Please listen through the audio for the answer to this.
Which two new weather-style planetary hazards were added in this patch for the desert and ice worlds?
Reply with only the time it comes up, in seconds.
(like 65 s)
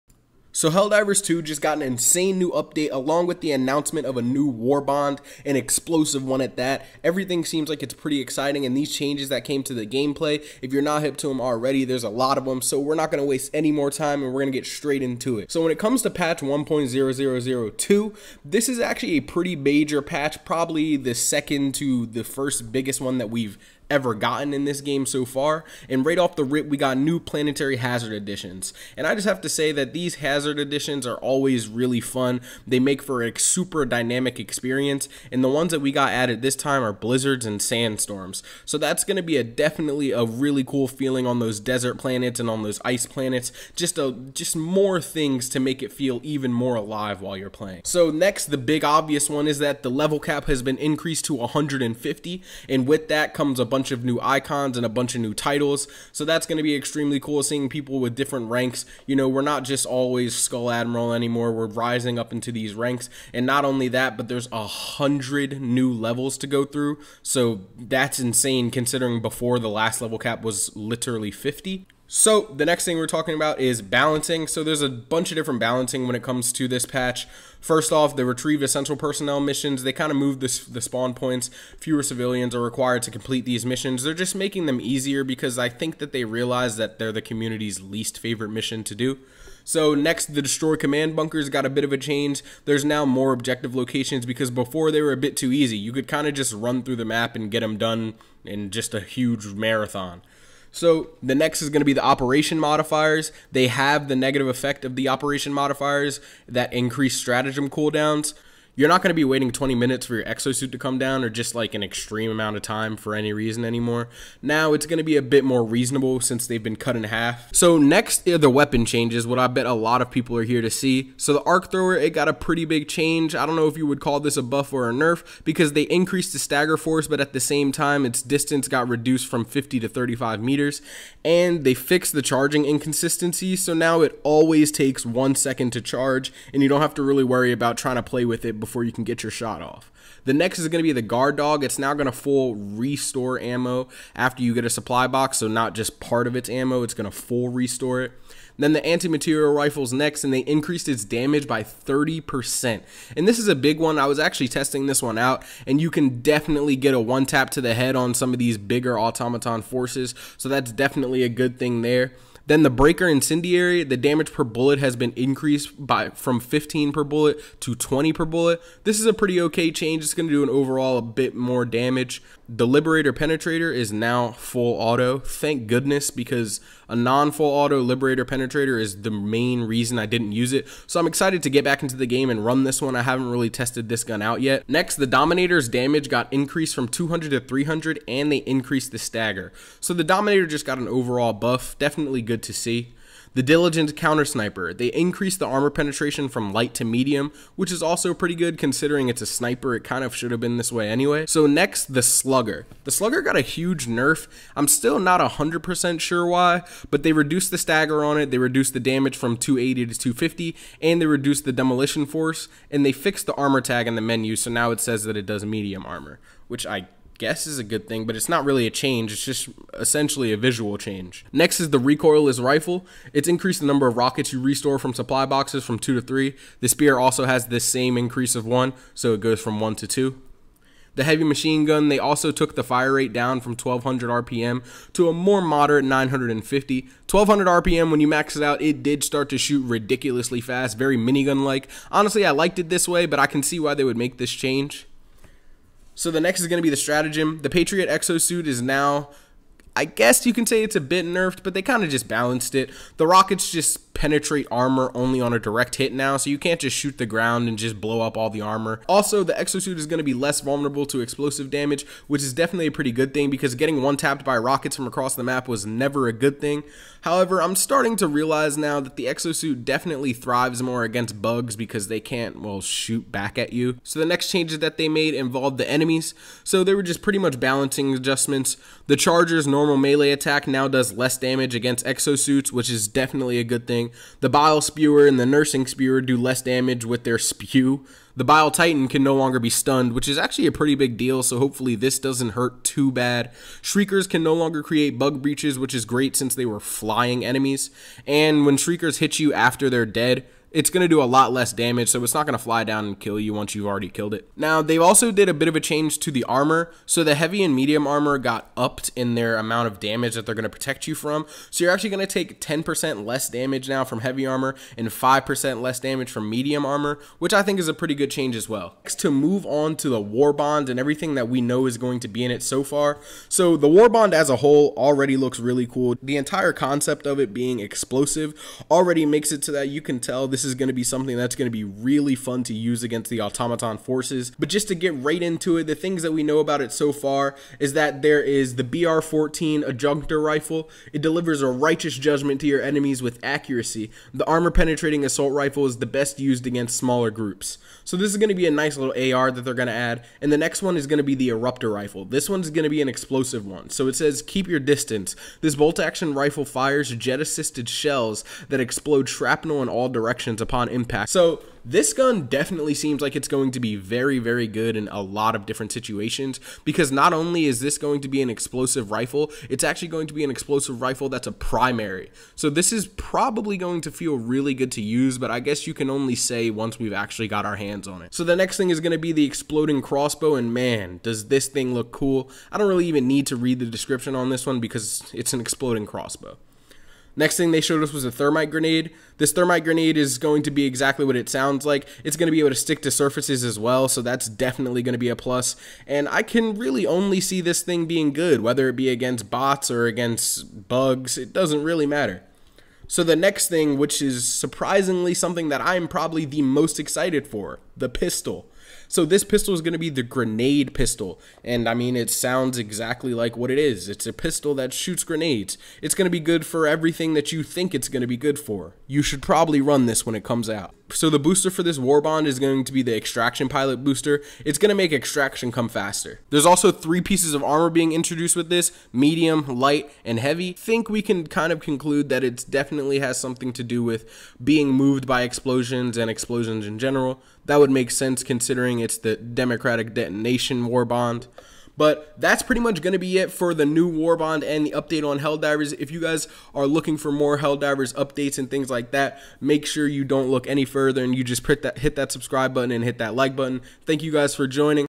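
36 s.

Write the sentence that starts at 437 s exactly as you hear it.
That would make sense considering it's the Democratic Detonation war bond.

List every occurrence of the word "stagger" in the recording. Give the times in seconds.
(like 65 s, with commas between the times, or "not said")
126 s, 188 s, 207 s.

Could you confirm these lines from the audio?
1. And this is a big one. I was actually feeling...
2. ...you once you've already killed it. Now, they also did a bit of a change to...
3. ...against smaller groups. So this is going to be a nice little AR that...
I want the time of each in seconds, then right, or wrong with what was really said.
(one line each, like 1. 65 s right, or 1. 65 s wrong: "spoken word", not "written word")
1. 153 s wrong: "testing", not "feeling"
2. 303 s right
3. 346 s right.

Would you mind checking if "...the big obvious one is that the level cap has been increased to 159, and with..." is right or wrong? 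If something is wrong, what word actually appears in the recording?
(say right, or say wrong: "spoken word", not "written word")
wrong: "150", not "159".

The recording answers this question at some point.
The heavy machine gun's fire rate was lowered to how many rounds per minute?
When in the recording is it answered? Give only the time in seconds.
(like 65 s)
235 s.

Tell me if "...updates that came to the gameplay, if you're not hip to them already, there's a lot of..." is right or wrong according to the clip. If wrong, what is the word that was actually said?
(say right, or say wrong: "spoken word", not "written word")
wrong: "changes", not "updates".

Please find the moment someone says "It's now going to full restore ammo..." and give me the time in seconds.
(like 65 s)
141 s.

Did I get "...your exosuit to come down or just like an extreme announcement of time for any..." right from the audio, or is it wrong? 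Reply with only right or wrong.
wrong.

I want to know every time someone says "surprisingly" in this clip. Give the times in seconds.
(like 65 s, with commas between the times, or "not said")
404 s.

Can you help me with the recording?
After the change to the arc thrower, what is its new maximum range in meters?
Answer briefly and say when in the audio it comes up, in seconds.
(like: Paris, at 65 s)
35, at 129 s.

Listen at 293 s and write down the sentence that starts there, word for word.
Shriekers can no longer create bug breaches, which is great since they were flying enemies.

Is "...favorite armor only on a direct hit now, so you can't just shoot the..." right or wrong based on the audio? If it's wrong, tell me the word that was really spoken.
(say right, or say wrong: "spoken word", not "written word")
wrong: "penetrate", not "favorite".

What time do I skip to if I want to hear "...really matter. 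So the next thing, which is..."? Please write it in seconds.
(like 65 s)
401 s.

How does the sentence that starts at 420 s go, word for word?
So the booster for this war bond is going to be the Extraction Pilot booster.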